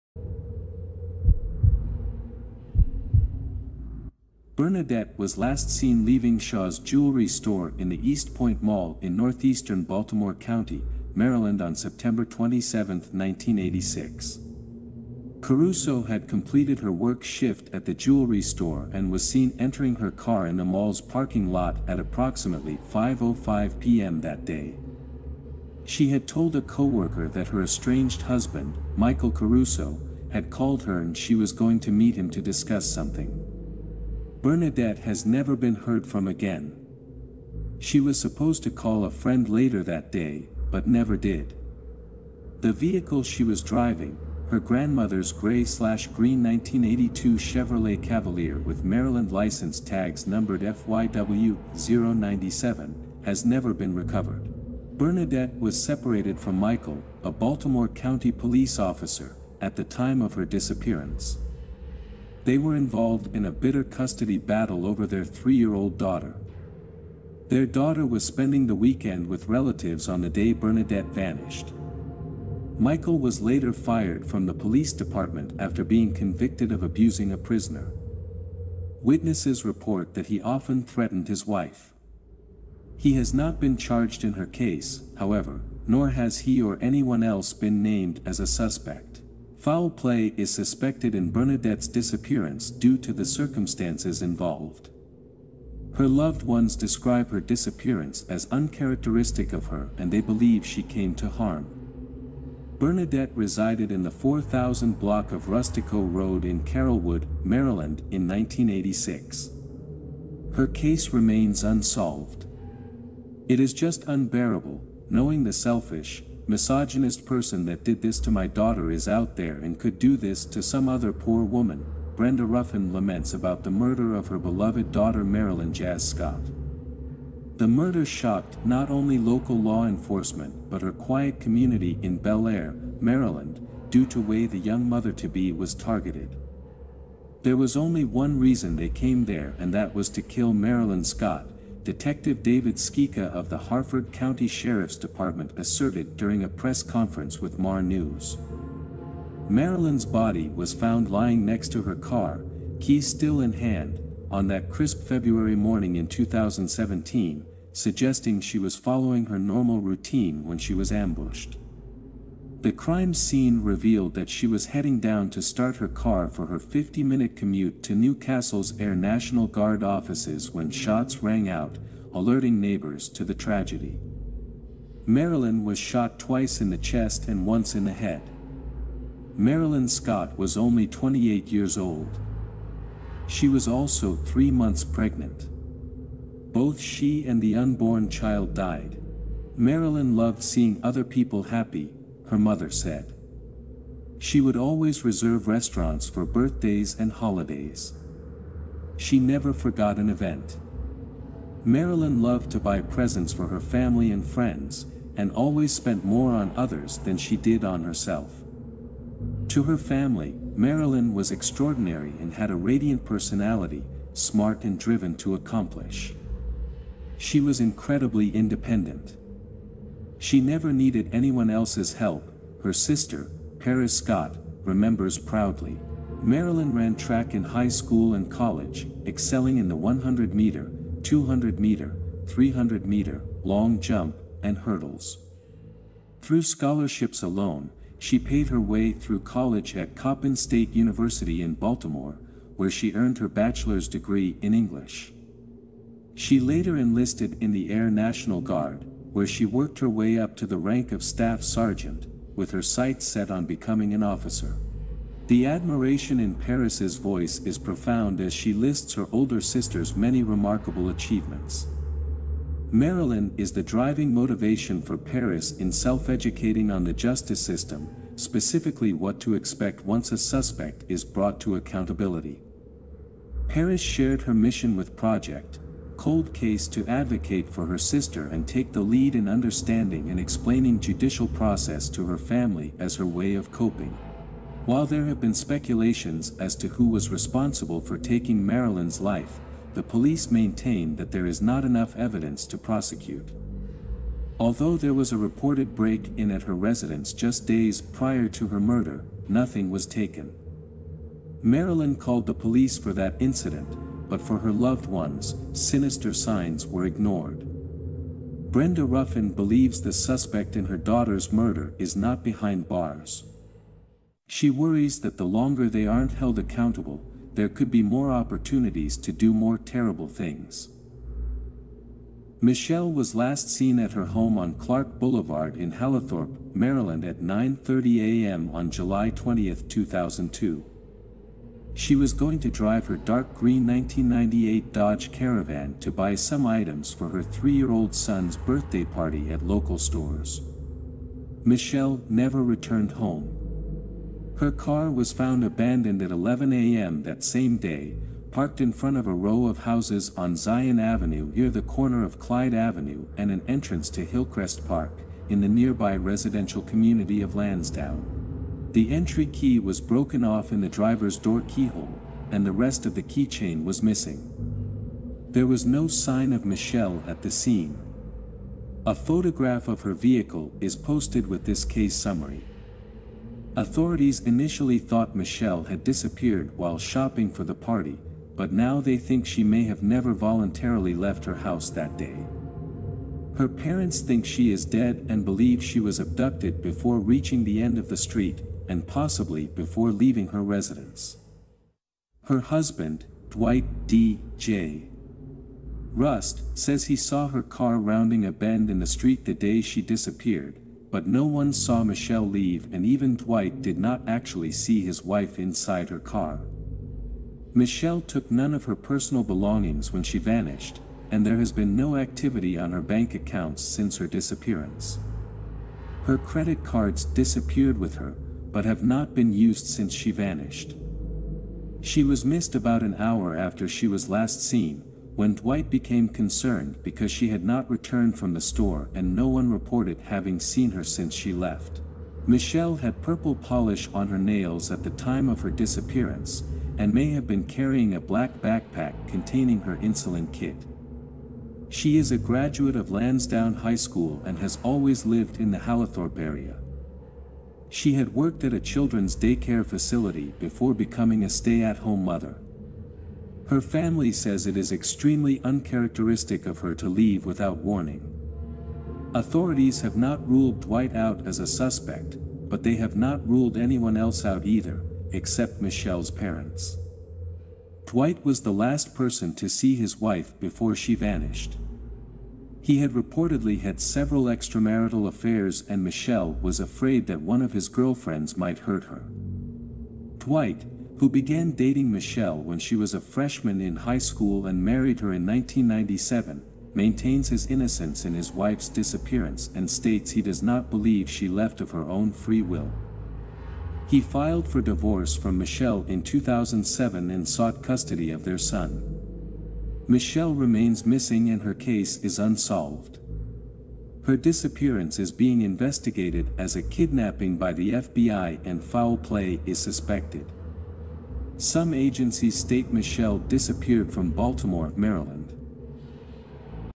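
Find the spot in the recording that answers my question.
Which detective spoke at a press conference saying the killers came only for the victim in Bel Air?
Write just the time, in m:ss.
2:22.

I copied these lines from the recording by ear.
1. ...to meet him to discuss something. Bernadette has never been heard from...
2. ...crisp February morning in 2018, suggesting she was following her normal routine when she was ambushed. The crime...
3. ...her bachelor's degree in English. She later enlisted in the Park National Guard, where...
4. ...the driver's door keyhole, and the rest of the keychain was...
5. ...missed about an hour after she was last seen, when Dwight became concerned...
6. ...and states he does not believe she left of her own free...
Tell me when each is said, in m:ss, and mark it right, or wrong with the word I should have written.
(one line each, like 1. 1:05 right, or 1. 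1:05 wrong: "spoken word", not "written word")
1. 0:31 right
2. 2:34 wrong: "2017", not "2018"
3. 4:03 wrong: "Air", not "Park"
4. 6:00 right
5. 7:02 right
6. 8:09 right.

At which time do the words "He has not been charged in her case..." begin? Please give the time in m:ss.
1:22.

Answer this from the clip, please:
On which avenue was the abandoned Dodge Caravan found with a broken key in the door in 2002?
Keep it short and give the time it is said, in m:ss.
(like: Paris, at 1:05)
Zion Avenue, at 5:50.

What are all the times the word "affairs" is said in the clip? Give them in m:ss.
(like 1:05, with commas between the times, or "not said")
7:55.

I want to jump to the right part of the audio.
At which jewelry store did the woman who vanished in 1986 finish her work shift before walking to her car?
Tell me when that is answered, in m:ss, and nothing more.
0:06.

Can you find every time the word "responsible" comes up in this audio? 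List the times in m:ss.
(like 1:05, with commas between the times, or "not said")
4:47.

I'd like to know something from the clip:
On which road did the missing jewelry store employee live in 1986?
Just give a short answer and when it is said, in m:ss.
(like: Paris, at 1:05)
Rustico Road, at 1:45.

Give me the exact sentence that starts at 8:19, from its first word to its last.
Michelle remains missing and her case is unsolved.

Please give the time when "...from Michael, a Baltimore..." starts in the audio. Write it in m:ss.
0:56.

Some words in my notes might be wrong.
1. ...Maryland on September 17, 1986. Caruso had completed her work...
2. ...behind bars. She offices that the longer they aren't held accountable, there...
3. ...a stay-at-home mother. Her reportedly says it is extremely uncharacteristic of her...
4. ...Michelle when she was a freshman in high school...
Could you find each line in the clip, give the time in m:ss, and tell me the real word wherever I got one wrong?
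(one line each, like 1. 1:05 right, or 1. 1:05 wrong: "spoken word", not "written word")
1. 0:11 wrong: "27", not "17"
2. 5:12 wrong: "worries", not "offices"
3. 7:31 wrong: "family", not "reportedly"
4. 8:01 right.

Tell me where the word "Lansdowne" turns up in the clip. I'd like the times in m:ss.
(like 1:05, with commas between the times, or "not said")
5:57, 7:22.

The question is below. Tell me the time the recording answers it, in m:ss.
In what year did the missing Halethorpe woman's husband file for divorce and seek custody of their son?
8:16.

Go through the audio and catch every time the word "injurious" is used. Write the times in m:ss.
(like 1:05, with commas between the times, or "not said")
not said.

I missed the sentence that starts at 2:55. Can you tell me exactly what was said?
Marilyn was shot twice in the chest and once in the head.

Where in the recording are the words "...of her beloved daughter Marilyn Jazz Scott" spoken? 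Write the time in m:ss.
2:04.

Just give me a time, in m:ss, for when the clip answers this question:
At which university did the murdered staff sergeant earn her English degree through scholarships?
3:59.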